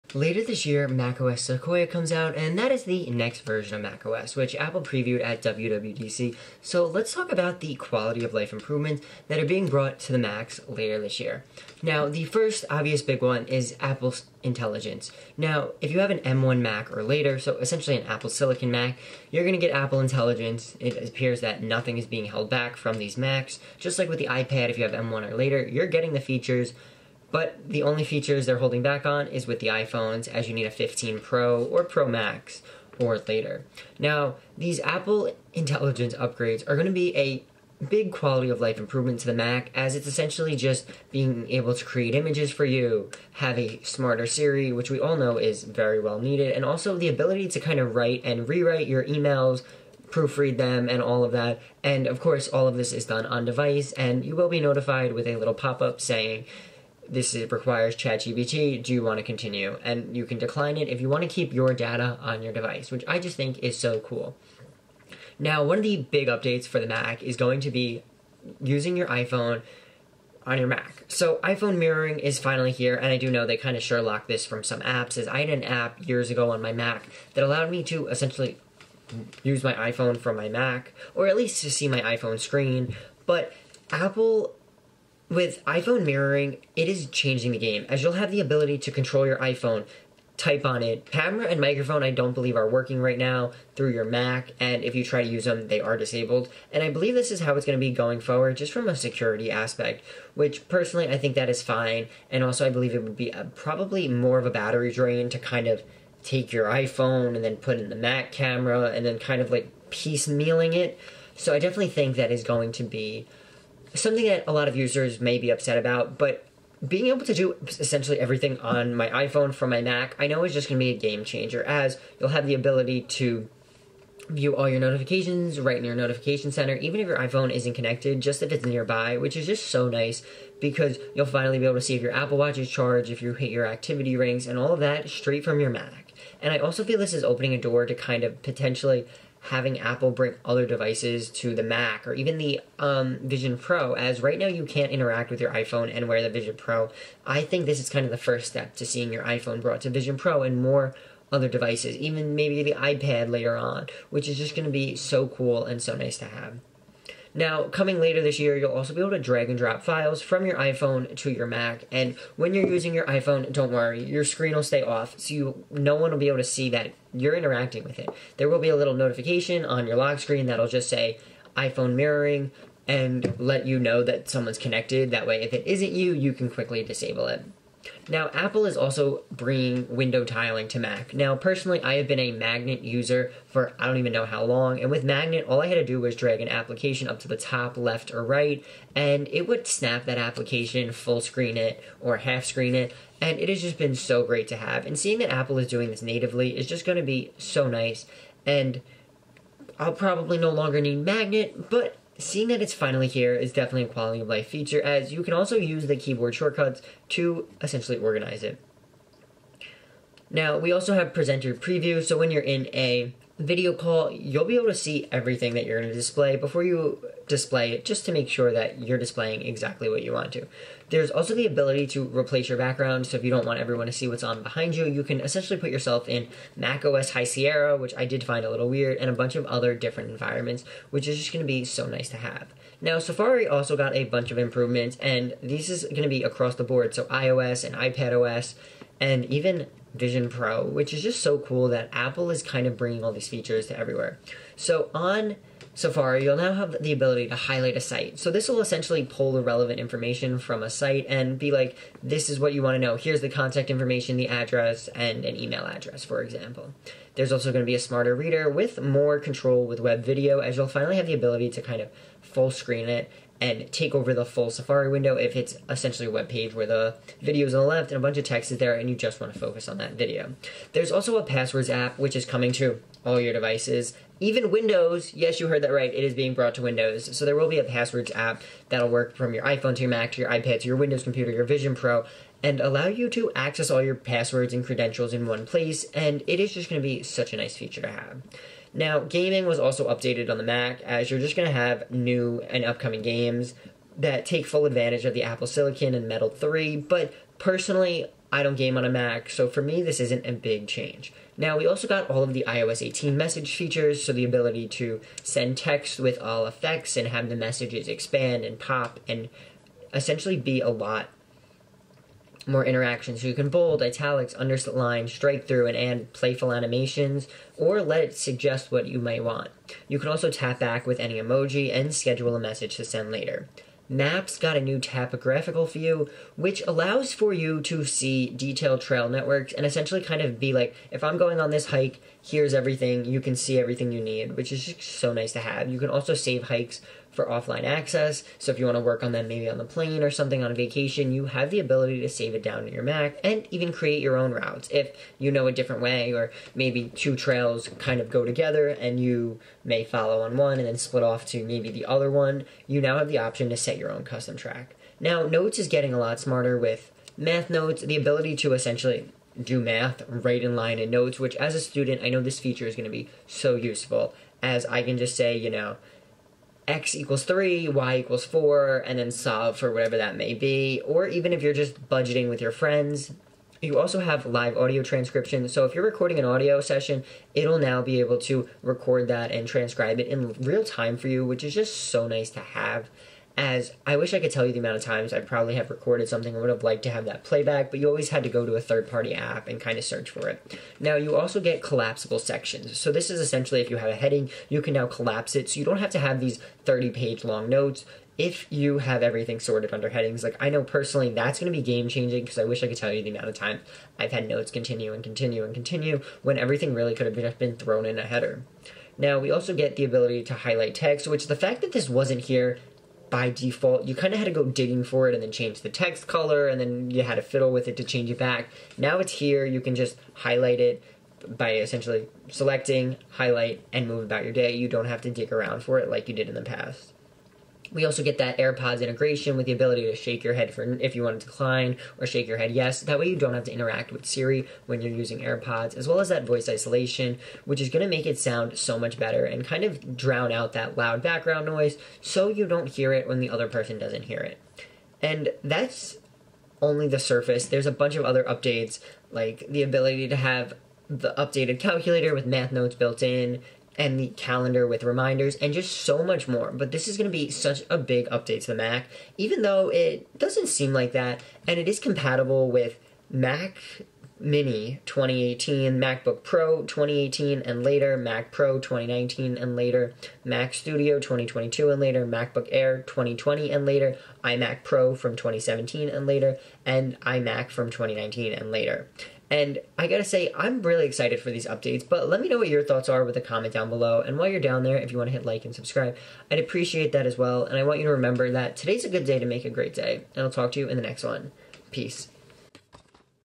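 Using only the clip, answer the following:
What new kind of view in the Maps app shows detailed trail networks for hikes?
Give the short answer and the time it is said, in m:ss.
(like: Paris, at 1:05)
Topographical view, at 5:24.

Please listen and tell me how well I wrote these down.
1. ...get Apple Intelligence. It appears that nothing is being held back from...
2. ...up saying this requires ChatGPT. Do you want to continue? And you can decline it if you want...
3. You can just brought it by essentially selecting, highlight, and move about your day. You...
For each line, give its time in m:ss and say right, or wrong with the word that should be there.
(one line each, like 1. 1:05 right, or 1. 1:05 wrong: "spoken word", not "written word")
1. 0:19 right
2. 0:55 right
3. 6:59 wrong: "highlight", not "brought".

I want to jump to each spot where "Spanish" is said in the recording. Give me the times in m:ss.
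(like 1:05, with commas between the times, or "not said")
not said.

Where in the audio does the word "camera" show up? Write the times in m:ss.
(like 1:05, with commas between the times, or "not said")
1:31, 1:48.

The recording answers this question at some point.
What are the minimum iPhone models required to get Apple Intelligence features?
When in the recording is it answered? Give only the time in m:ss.
0:30.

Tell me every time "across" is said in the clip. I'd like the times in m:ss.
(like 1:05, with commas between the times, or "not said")
3:56.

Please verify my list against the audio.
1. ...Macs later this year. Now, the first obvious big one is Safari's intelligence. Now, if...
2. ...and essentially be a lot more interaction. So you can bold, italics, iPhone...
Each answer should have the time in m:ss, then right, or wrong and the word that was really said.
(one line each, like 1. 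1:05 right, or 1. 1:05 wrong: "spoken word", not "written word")
1. 0:10 wrong: "Apple", not "Safari"
2. 5:09 wrong: "underline", not "iPhone".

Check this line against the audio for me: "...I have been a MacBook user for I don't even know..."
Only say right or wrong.
wrong.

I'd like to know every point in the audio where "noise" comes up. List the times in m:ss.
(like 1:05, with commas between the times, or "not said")
7:21.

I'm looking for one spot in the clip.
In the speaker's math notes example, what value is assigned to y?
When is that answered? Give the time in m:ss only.
6:07.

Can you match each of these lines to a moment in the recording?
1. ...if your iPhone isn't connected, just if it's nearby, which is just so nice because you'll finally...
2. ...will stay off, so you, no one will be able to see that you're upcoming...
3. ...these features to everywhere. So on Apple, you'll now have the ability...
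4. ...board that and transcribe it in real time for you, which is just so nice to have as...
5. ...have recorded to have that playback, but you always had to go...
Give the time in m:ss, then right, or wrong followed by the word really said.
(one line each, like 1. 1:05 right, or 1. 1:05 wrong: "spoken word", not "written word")
1. 2:07 right
2. 2:44 wrong: "interacting", not "upcoming"
3. 4:03 wrong: "Safari", not "Apple"
4. 6:18 wrong: "record", not "board"
5. 6:26 wrong: "liked", not "recorded".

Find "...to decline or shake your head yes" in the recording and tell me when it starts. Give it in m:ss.
7:11.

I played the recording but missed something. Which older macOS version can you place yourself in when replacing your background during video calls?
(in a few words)
High Sierra.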